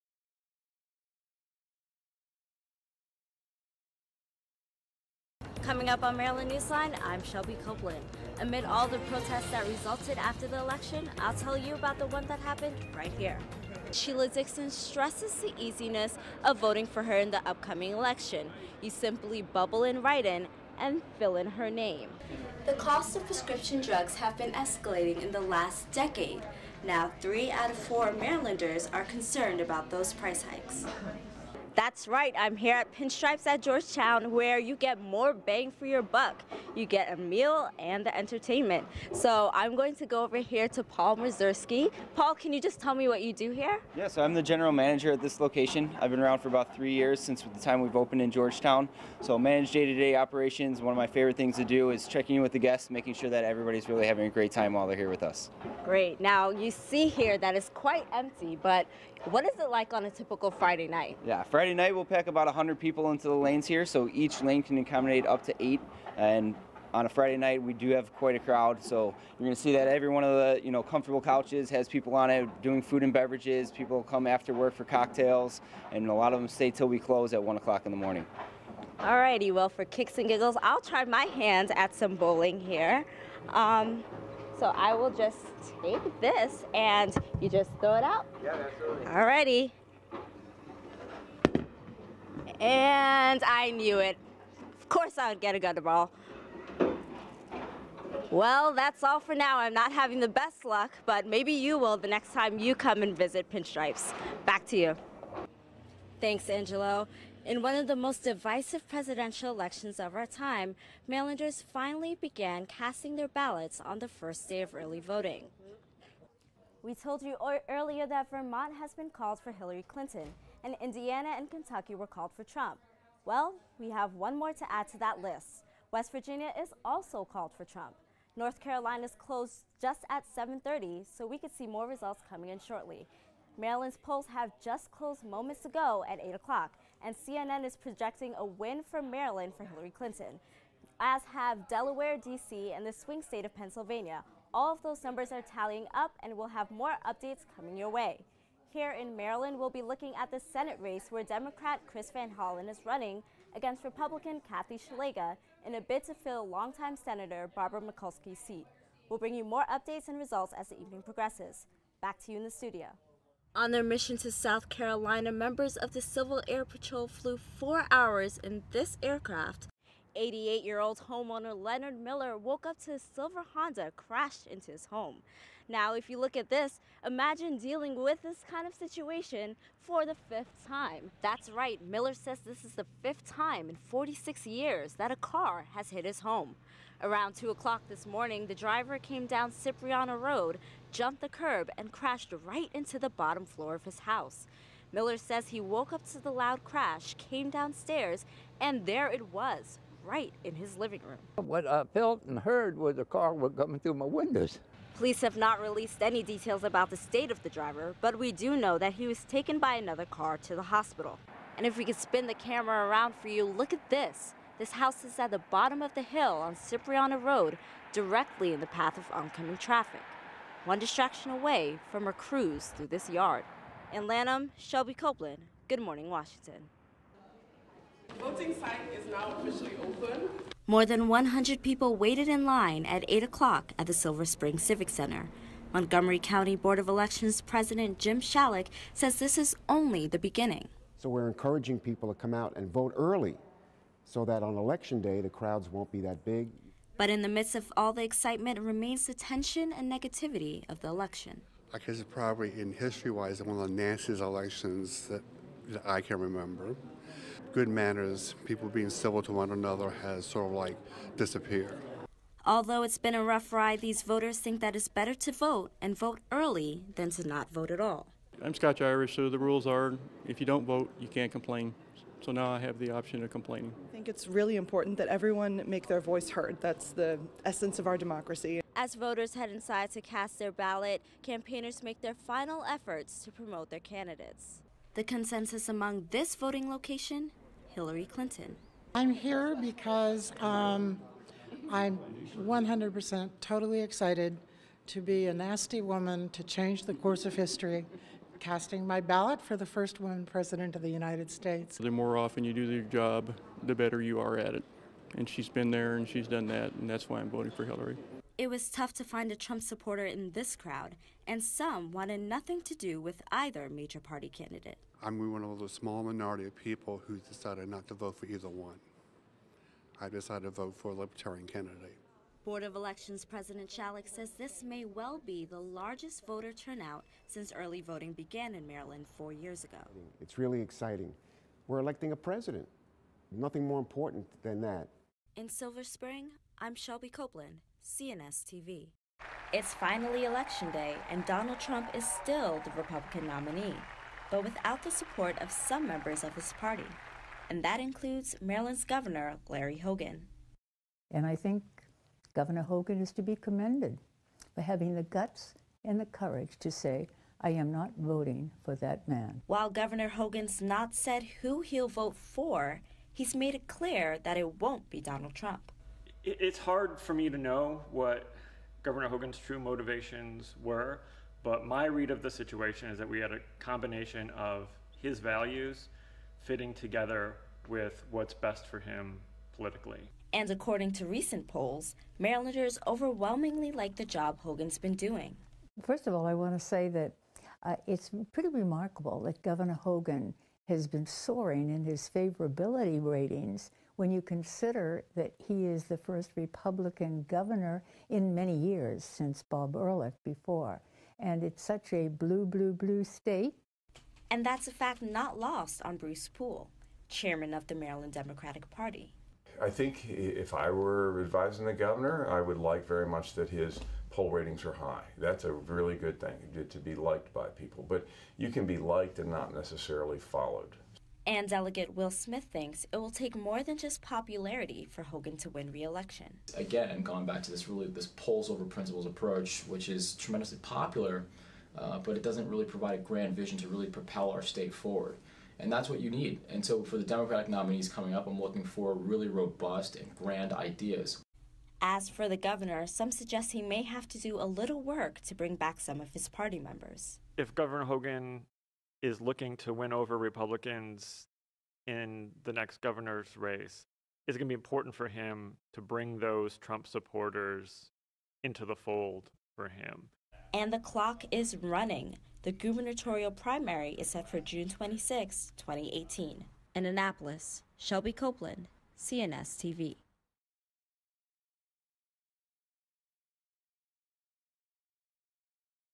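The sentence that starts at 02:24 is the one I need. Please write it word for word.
All of those numbers are tallying up, and we'll have more updates coming your way.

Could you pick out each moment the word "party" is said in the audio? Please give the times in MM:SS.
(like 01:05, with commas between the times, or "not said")
05:13, 05:46, 06:48, 07:26.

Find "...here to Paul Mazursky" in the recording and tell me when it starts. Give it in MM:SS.
00:40.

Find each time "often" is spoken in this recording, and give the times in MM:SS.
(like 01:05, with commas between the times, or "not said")
05:02.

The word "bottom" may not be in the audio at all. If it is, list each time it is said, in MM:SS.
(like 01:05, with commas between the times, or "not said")
03:13, 03:35.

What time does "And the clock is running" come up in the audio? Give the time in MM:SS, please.
07:40.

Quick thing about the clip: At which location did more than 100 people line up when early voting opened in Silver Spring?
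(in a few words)
Silver Spring Civic Center.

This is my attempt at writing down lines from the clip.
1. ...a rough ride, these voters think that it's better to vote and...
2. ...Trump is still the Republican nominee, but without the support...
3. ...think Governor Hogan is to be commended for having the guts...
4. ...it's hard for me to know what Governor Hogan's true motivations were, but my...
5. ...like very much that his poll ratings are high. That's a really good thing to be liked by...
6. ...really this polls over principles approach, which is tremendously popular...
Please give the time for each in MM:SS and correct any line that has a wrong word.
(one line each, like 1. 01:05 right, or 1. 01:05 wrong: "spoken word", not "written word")
1. 04:23 right
2. 05:41 right
3. 05:51 right
4. 06:06 right
5. 06:52 right
6. 07:07 right.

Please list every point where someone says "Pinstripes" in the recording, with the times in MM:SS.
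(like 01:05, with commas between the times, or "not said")
00:32, 01:43.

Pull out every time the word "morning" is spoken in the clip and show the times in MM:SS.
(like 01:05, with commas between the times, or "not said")
01:17, 03:08, 03:45.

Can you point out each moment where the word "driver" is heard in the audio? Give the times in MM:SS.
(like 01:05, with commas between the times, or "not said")
03:08, 03:27.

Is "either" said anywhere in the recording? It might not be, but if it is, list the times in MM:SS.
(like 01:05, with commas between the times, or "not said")
05:13, 05:18.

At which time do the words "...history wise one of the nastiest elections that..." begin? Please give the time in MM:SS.
04:12.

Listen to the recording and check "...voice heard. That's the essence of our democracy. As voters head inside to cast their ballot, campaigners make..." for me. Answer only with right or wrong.
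right.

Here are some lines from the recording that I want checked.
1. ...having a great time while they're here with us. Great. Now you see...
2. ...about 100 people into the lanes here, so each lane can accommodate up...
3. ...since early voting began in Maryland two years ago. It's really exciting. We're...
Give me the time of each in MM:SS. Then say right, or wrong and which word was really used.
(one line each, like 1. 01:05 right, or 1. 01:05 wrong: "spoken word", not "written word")
1. 00:54 right
2. 01:02 right
3. 05:27 wrong: "four", not "two".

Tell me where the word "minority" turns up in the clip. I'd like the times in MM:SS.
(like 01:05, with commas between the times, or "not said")
05:16.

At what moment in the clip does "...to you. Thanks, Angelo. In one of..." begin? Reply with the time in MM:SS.
01:44.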